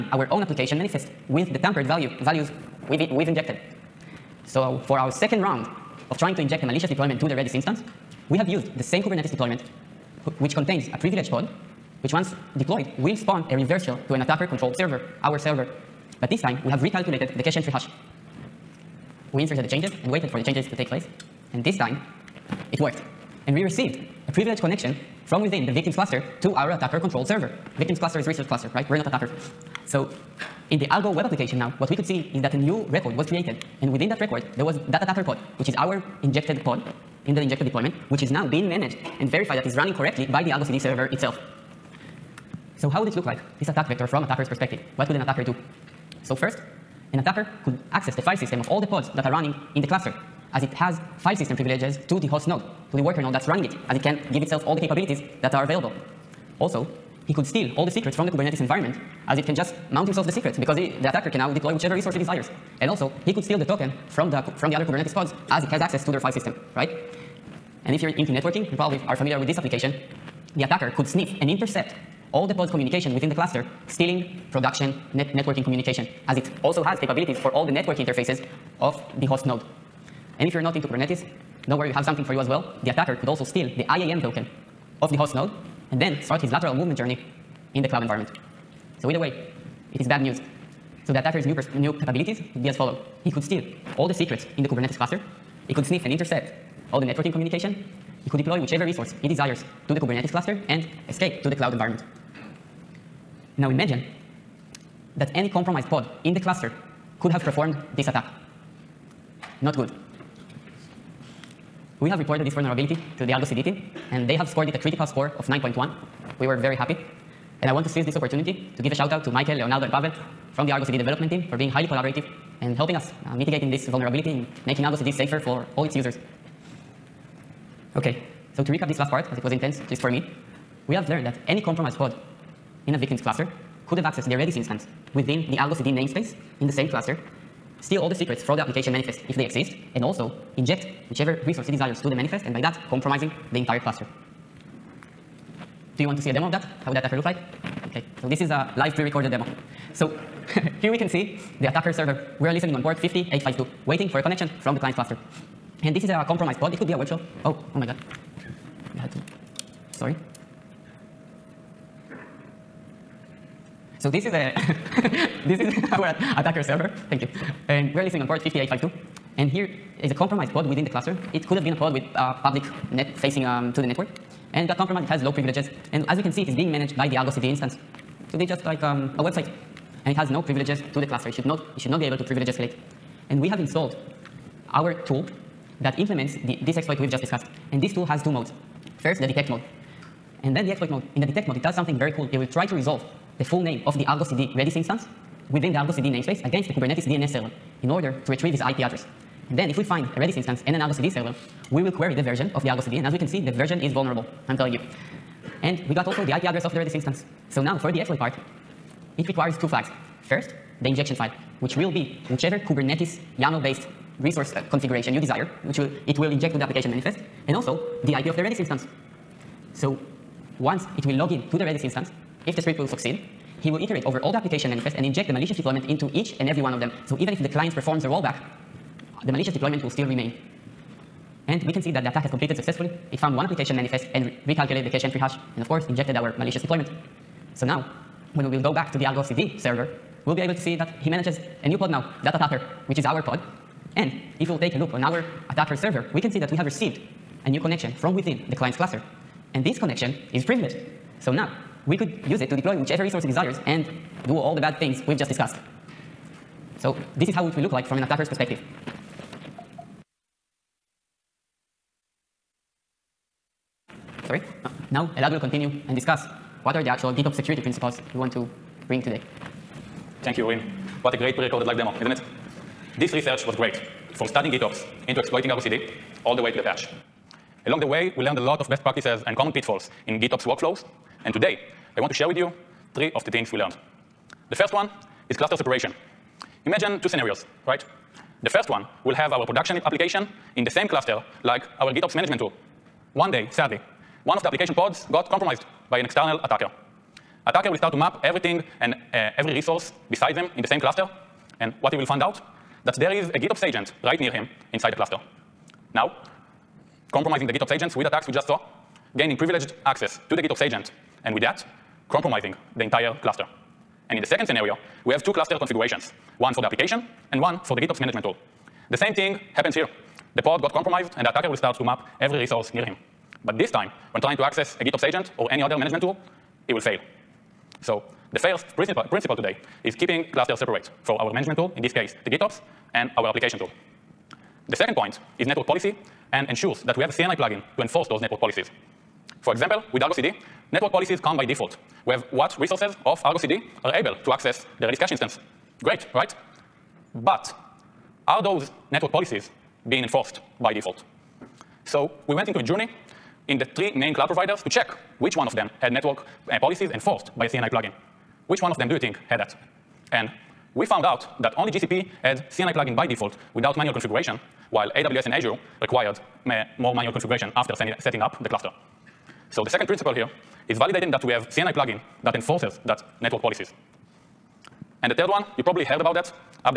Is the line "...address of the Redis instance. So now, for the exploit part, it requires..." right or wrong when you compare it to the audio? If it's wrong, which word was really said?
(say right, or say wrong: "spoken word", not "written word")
right.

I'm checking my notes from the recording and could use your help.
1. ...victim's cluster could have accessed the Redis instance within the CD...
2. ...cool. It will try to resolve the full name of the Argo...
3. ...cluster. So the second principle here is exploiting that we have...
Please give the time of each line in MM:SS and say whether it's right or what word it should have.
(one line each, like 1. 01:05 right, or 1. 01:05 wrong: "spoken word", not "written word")
1. 02:12 right
2. 03:12 right
3. 06:08 wrong: "validating", not "exploiting".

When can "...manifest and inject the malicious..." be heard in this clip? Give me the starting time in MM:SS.
03:44.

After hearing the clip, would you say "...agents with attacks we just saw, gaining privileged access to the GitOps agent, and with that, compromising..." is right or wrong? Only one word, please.
right.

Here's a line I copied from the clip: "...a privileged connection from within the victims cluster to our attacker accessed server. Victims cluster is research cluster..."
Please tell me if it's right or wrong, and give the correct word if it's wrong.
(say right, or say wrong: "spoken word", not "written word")
wrong: "controlled", not "accessed".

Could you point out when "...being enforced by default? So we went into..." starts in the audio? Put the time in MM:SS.
05:49.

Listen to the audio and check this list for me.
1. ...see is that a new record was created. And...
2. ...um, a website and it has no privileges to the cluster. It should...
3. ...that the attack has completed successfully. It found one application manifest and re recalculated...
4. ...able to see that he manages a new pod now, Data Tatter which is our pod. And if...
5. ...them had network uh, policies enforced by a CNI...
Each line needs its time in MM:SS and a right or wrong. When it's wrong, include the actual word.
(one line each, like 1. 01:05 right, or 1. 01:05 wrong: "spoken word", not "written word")
1. 00:32 right
2. 02:58 right
3. 03:51 right
4. 04:00 right
5. 05:55 right.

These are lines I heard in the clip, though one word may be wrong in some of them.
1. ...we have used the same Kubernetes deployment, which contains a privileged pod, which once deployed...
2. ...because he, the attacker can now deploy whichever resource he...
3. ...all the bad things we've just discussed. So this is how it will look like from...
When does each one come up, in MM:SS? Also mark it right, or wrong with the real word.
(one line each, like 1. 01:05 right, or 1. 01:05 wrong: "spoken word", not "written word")
1. 00:08 right
2. 01:00 right
3. 04:14 right.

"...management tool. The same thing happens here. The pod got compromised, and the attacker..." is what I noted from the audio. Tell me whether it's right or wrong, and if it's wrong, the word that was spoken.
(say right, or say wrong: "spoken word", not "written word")
right.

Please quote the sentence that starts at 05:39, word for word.
For example, with Argo CD, network policies come by default.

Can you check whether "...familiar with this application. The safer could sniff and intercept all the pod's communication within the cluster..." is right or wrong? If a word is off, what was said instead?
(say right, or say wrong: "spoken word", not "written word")
wrong: "attacker", not "safer".